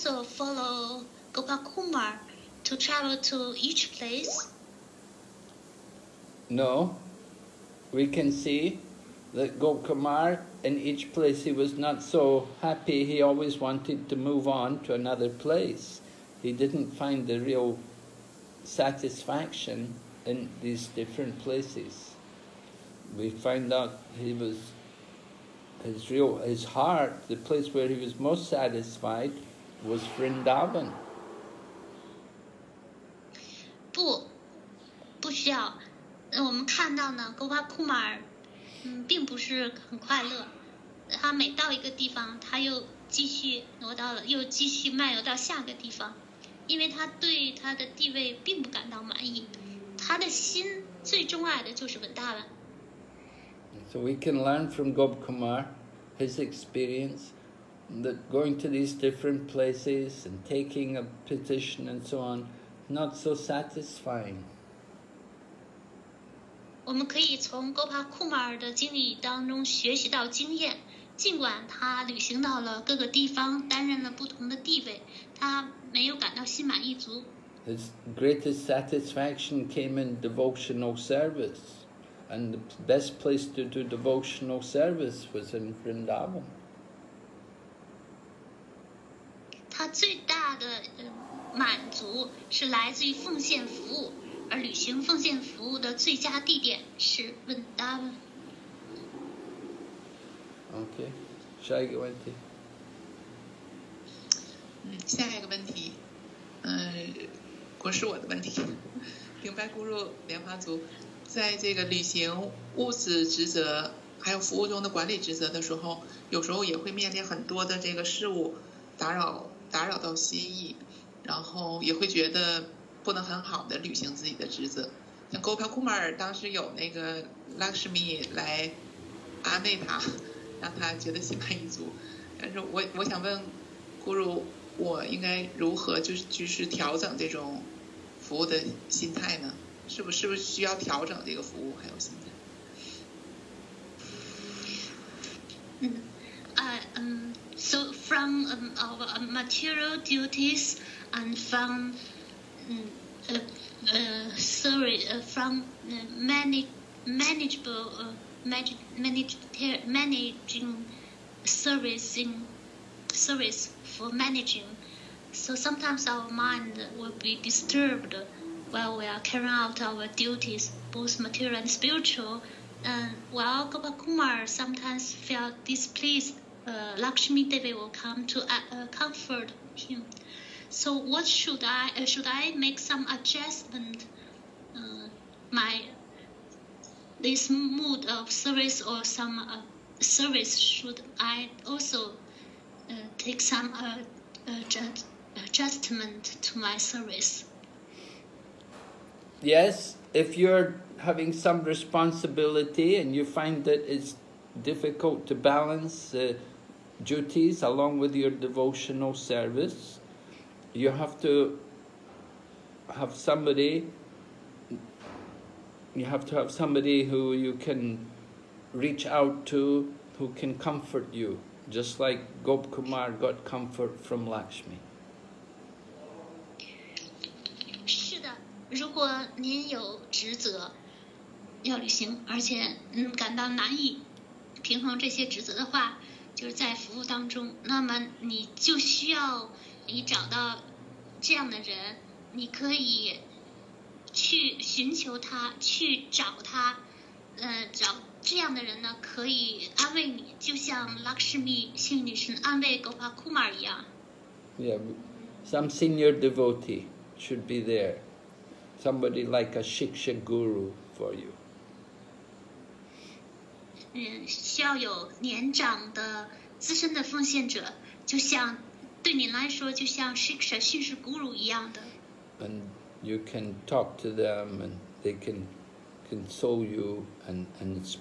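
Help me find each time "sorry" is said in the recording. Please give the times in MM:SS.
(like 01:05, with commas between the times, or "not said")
02:34.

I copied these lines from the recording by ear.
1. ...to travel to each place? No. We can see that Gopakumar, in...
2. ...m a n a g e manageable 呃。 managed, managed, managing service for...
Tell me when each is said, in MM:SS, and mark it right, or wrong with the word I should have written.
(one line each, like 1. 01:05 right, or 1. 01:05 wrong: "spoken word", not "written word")
1. 00:02 right
2. 02:36 right.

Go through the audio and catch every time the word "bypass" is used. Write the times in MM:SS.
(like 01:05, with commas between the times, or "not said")
not said.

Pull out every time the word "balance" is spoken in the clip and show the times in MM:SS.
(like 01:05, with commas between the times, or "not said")
03:25.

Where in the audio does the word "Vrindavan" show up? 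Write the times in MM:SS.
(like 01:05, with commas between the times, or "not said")
00:30, 01:25, 01:37.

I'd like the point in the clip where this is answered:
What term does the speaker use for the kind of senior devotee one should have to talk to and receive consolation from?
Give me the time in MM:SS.
04:19.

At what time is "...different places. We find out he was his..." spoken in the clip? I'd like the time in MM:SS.
00:20.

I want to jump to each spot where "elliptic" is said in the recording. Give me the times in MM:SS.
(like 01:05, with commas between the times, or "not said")
not said.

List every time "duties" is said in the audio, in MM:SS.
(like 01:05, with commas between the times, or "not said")
02:30, 02:50, 03:27.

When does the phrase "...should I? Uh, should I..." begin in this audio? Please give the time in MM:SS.
03:01.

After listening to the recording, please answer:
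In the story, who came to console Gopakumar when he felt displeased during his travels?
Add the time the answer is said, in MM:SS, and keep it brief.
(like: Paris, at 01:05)
Lakshmi Devi, at 02:56.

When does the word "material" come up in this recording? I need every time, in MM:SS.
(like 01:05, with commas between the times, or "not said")
02:29, 02:51.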